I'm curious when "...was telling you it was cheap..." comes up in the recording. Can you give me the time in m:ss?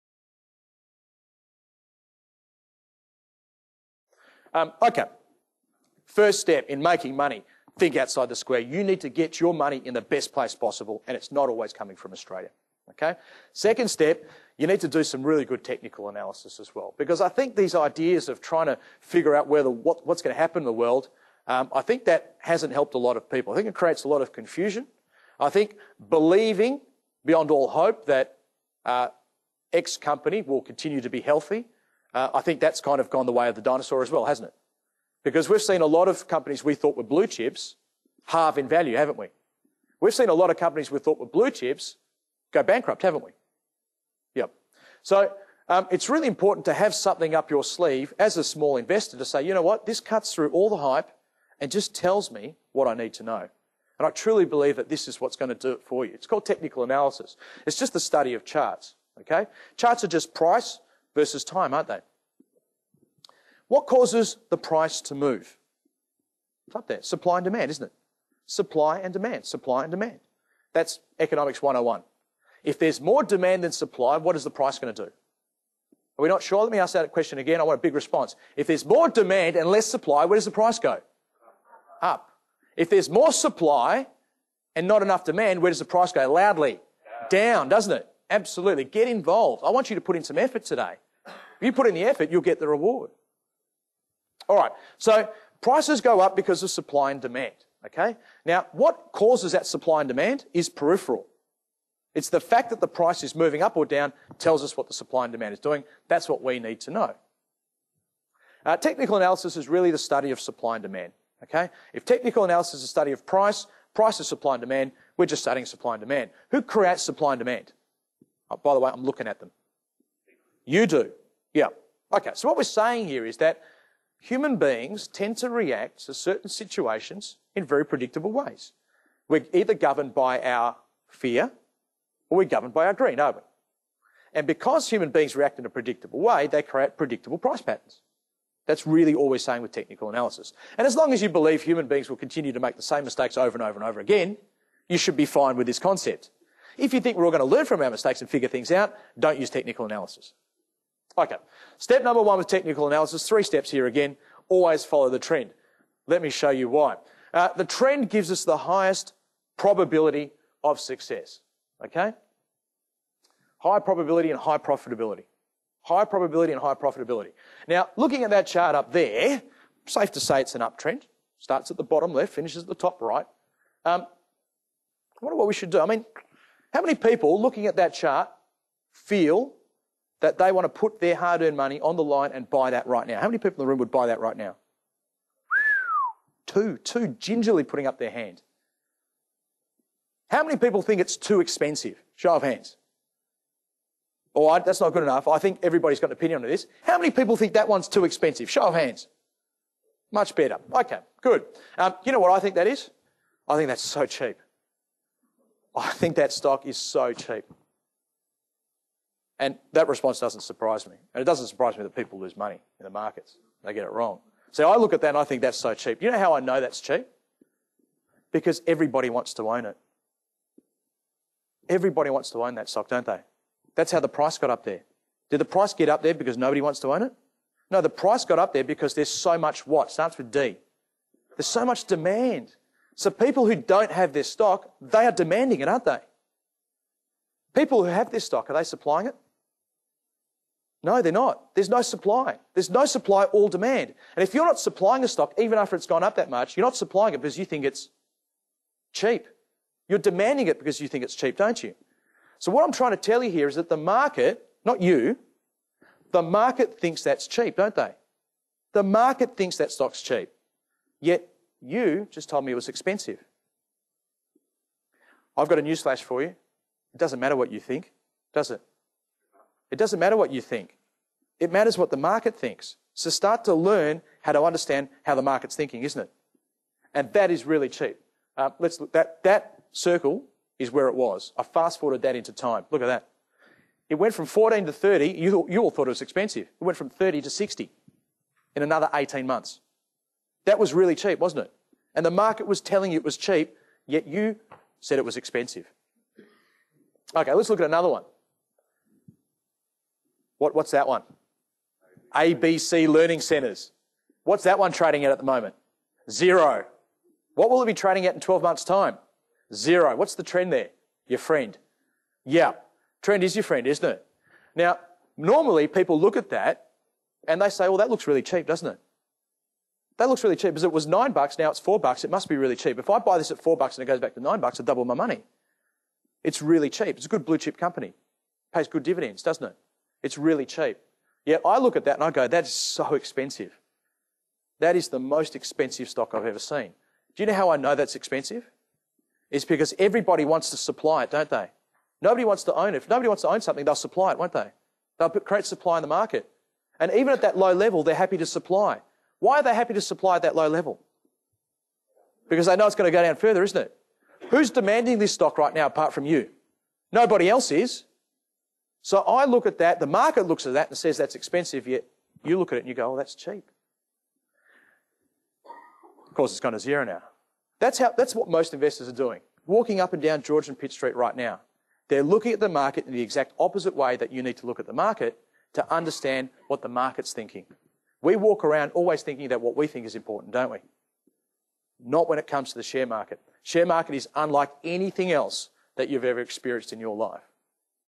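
4:52.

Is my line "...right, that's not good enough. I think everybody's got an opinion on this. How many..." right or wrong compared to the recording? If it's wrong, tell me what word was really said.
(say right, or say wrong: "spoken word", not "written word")
right.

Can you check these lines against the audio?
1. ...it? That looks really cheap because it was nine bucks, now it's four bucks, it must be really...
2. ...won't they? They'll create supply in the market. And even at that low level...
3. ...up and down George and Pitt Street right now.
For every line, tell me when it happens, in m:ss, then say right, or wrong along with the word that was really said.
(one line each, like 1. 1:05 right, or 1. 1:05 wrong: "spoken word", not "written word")
1. 5:18 right
2. 5:44 right
3. 6:09 right.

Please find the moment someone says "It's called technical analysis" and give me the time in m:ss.
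0:56.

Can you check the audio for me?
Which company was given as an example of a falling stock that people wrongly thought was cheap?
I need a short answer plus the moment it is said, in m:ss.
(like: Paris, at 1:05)
ABC Learning Centers, at 5:02.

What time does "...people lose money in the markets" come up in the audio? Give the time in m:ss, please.
3:31.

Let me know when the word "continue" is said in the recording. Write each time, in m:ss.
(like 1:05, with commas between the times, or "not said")
0:30, 2:22.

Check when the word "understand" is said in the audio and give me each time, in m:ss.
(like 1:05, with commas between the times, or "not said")
4:34, 6:15.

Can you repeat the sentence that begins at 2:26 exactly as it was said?
If you think we're all going to learn from our mistakes and figure things out, don't use technical analysis.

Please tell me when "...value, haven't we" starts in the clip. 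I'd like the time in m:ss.
0:38.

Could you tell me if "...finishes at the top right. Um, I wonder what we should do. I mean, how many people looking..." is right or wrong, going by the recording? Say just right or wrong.
right.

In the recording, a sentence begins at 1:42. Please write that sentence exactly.
It's the fact that the price is moving up or down tells us what the supply and demand is doing.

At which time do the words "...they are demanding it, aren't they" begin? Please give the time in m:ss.
3:54.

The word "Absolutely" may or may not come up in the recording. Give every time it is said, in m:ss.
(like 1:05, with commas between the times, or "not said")
1:28.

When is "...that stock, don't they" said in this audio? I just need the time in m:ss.
3:42.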